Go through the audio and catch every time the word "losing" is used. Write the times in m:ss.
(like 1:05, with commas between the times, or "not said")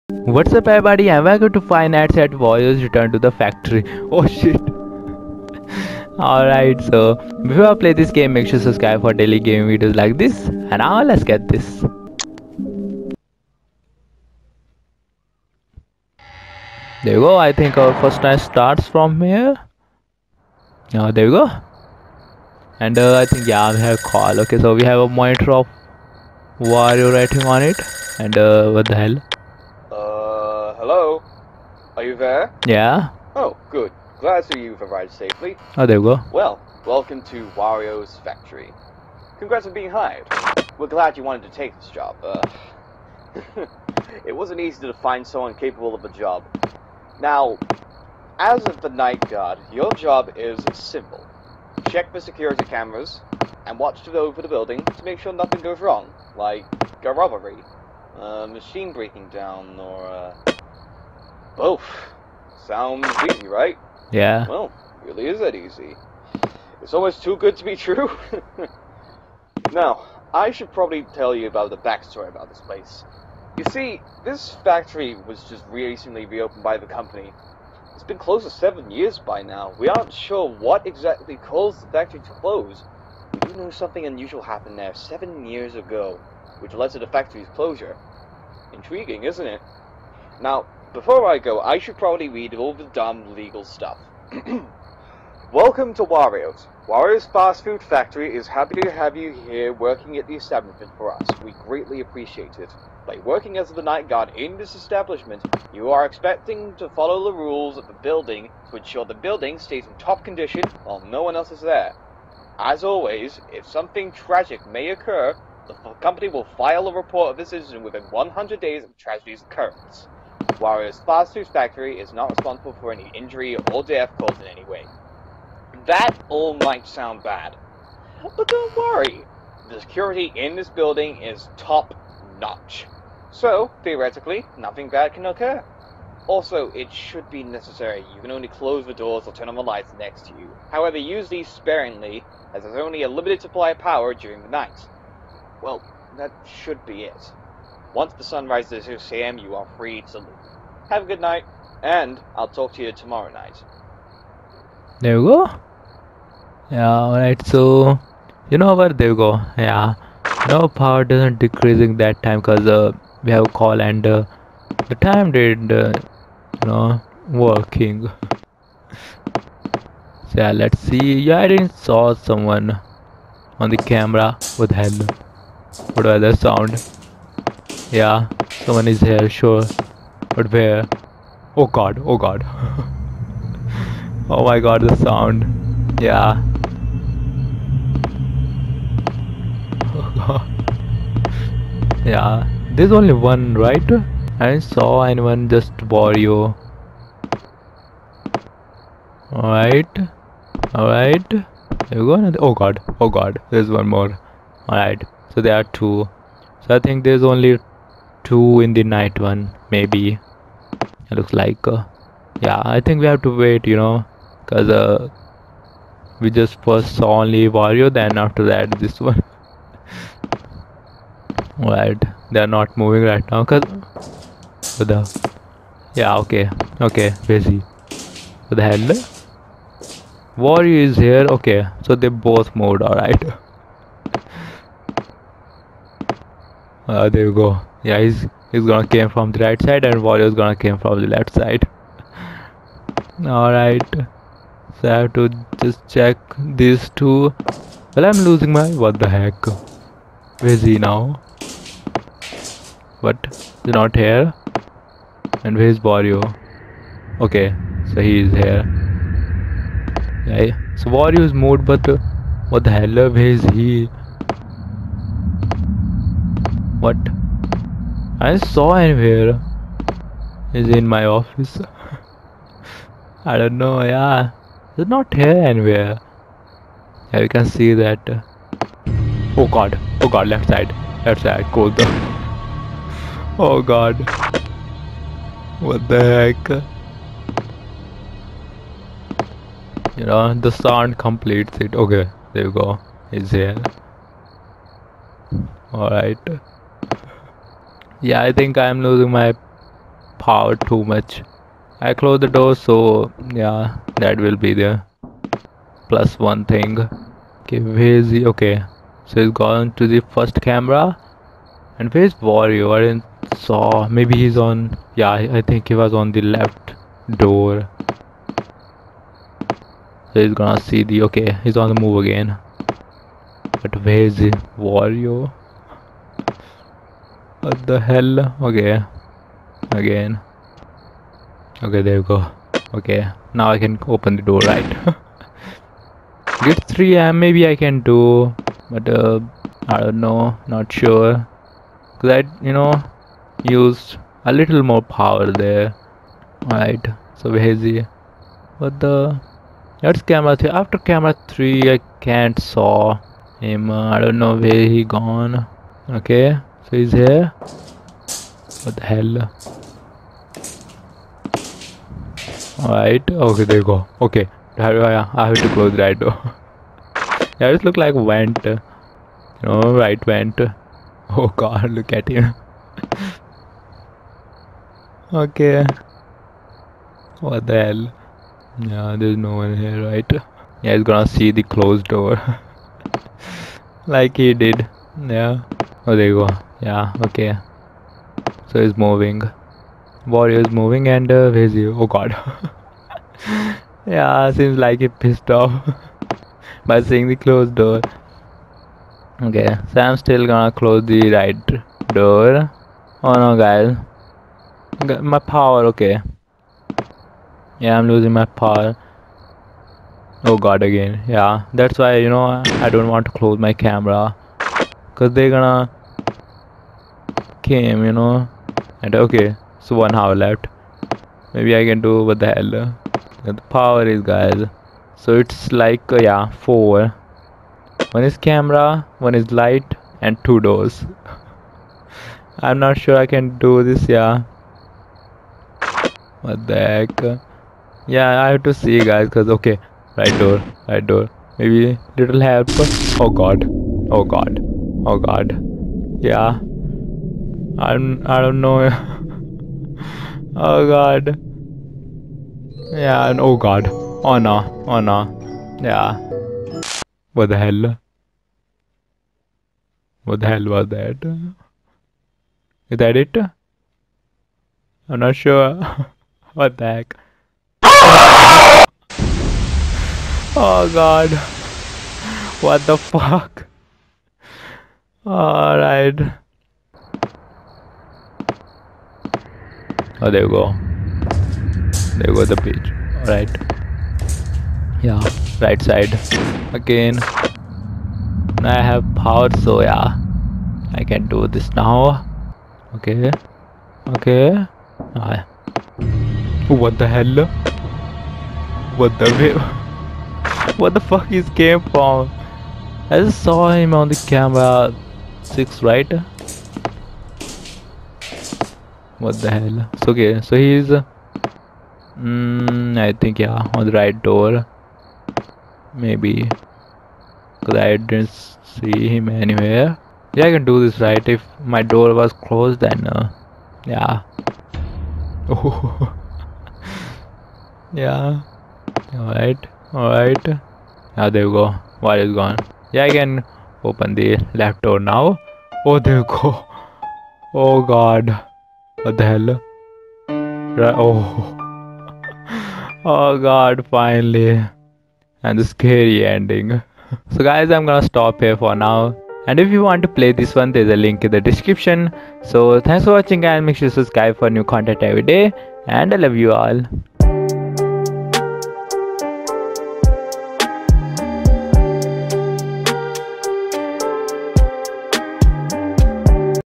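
4:08, 4:58, 6:47.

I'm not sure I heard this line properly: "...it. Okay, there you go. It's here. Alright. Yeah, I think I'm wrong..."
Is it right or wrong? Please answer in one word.
wrong.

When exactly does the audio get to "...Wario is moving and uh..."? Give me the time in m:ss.
6:30.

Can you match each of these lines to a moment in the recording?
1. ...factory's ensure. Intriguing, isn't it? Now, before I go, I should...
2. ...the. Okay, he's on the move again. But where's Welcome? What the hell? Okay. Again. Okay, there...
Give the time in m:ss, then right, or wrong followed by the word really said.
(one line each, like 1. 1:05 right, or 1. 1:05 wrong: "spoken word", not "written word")
1. 1:27 wrong: "closure", not "ensure"
2. 5:20 wrong: "Wario", not "Welcome".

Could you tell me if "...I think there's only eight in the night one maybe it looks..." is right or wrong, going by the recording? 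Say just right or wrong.
wrong.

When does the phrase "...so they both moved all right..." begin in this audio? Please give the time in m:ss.
3:51.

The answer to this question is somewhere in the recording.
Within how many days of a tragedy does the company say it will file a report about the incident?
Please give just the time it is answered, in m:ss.
1:58.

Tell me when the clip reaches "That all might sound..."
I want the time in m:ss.
2:05.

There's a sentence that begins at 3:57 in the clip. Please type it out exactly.
Yeah, he's he's gonna came from the right side and Wario's gonna came from the left side.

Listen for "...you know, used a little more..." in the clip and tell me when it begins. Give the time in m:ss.
5:42.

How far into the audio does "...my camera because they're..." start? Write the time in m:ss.
6:53.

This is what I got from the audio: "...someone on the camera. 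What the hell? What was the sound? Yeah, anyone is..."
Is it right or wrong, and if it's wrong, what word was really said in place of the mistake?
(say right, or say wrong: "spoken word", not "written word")
wrong: "someone", not "anyone".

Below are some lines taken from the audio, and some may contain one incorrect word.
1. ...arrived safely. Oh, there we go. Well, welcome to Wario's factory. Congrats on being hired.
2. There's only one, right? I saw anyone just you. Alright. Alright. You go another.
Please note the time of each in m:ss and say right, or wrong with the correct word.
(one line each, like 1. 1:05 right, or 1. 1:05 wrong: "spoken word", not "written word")
1. 0:34 right
2. 3:12 right.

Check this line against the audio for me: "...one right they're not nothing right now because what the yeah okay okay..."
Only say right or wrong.
wrong.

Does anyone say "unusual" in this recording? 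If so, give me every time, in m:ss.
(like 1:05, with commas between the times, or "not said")
1:24.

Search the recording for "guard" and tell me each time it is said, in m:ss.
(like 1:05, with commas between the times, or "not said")
0:49, 1:44.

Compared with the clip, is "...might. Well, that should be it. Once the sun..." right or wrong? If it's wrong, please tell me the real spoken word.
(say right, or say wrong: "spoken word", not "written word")
wrong: "night", not "might".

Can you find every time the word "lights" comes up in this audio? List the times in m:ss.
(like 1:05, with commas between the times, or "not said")
2:19, 7:09.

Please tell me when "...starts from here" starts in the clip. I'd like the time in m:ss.
0:18.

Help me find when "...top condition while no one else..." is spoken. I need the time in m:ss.
1:49.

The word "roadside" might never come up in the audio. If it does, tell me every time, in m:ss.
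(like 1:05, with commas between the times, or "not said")
not said.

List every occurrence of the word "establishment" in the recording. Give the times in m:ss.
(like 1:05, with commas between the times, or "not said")
1:40, 1:44.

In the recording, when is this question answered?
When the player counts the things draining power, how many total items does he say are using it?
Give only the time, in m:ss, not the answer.
7:06.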